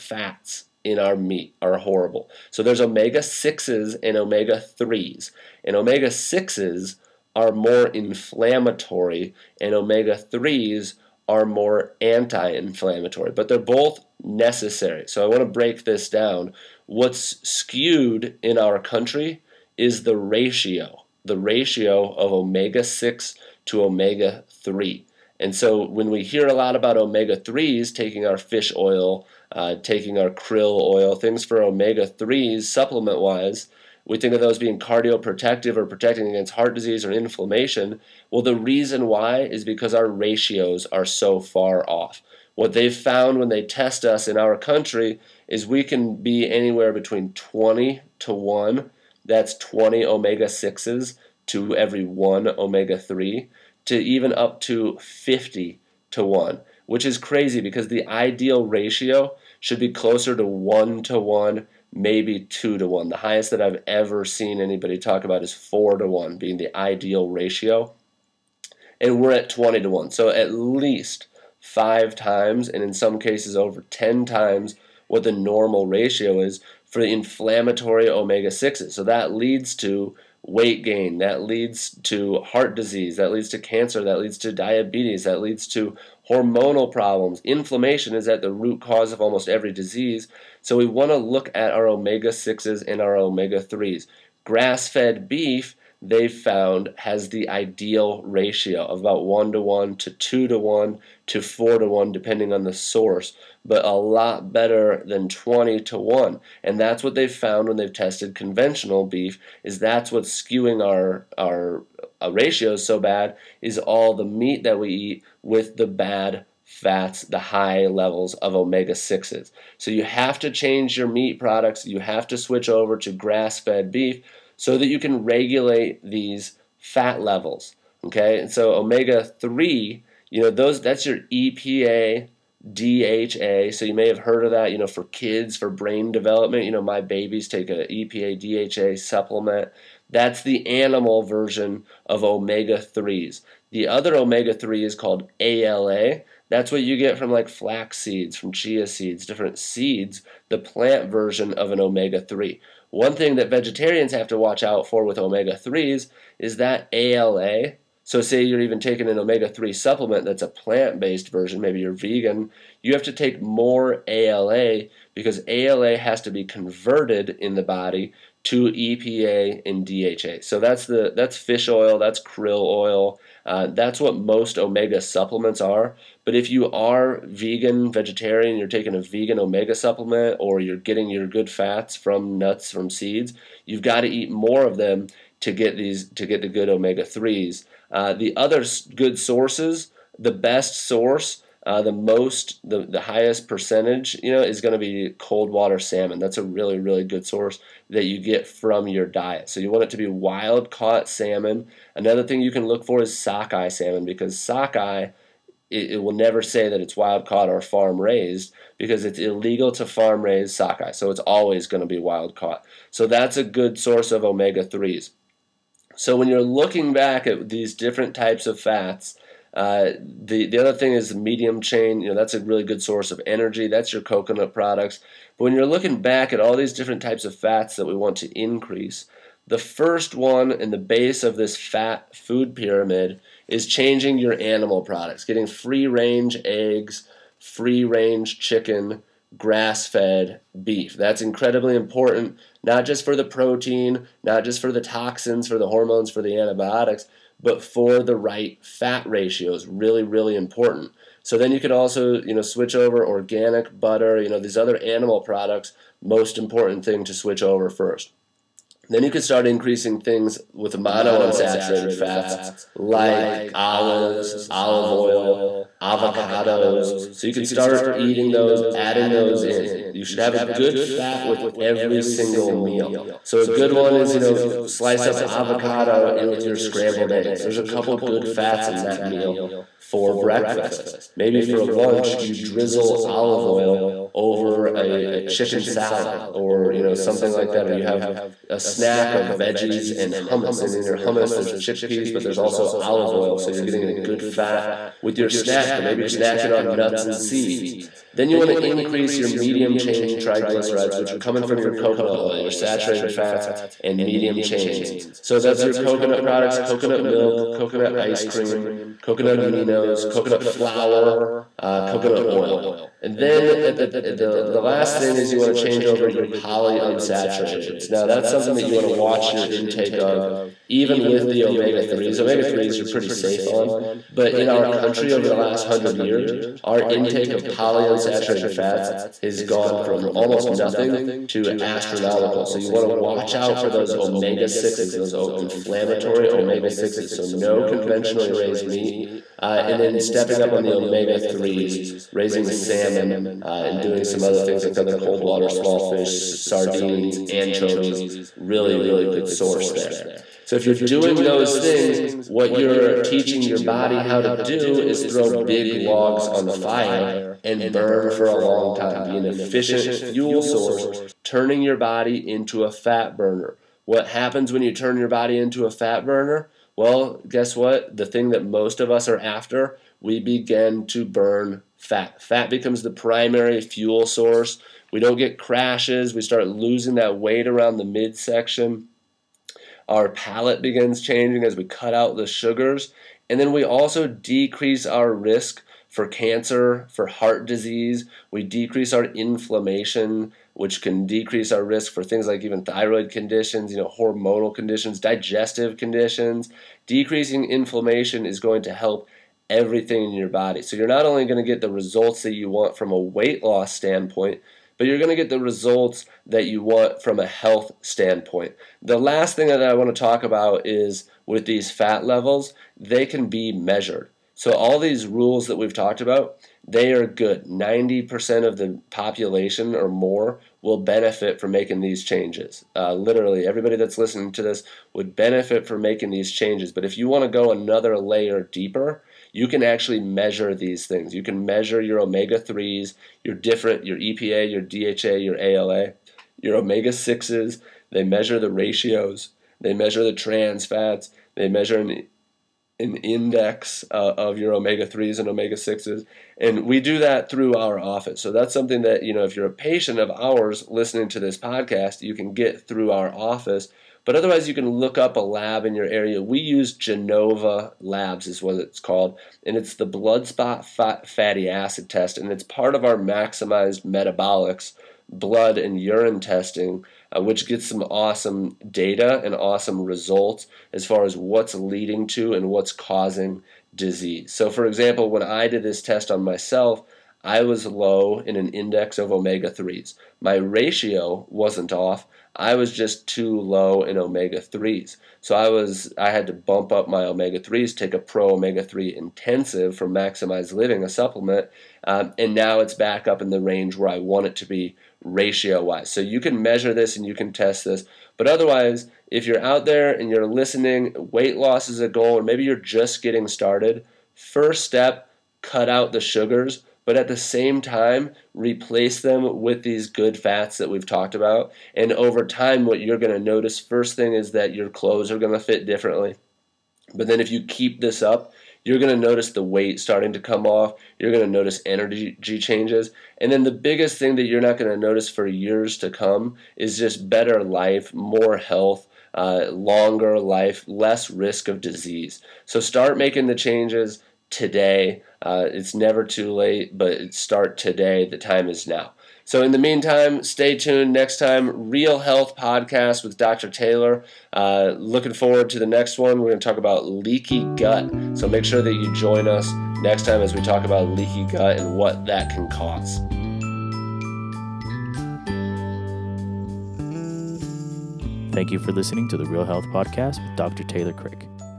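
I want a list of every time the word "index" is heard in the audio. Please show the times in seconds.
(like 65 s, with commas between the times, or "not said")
442 s, 478 s.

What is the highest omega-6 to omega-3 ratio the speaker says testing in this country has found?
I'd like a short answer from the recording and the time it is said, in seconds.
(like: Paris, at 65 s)
50 to 1, at 55 s.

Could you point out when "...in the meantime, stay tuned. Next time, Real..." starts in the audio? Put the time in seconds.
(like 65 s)
539 s.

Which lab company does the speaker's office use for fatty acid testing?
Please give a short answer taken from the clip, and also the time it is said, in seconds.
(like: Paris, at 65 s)
Genova Labs, at 456 s.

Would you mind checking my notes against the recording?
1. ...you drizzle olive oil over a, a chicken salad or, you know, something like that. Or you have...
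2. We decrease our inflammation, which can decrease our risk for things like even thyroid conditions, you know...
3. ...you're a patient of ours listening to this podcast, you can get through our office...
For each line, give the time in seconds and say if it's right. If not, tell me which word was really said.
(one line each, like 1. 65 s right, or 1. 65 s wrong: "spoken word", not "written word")
1. 282 s right
2. 388 s right
3. 449 s right.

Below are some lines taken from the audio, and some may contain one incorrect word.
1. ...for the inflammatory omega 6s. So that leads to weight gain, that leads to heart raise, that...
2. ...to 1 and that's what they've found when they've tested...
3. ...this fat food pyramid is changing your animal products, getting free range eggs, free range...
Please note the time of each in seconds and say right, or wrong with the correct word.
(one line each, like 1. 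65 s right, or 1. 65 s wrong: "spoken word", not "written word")
1. 76 s wrong: "disease", not "raise"
2. 105 s right
3. 231 s right.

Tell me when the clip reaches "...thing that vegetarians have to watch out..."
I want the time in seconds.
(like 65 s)
153 s.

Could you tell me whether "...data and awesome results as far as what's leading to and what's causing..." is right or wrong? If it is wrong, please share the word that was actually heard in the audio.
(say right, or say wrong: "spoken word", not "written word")
right.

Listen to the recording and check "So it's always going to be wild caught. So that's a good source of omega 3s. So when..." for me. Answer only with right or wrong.
right.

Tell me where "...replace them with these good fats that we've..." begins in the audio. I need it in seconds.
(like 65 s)
508 s.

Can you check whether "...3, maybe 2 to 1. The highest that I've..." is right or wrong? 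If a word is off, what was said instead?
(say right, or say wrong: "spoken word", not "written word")
wrong: "1", not "3".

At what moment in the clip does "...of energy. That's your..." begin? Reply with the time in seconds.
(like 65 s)
223 s.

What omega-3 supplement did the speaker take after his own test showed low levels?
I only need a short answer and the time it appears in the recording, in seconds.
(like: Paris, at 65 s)
Pro Omega 3 Intensive, at 487 s.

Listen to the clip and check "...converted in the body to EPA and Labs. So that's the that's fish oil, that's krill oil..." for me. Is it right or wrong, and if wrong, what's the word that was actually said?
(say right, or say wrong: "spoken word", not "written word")
wrong: "DHA", not "Labs".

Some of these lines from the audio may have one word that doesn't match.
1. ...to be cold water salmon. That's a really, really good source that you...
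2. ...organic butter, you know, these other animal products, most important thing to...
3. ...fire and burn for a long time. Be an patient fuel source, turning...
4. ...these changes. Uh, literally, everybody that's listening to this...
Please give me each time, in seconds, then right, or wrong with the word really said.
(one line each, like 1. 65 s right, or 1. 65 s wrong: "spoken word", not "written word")
1. 194 s right
2. 253 s right
3. 356 s wrong: "efficient", not "patient"
4. 421 s right.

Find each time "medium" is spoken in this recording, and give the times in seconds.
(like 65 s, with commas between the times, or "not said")
221 s, 299 s, 304 s.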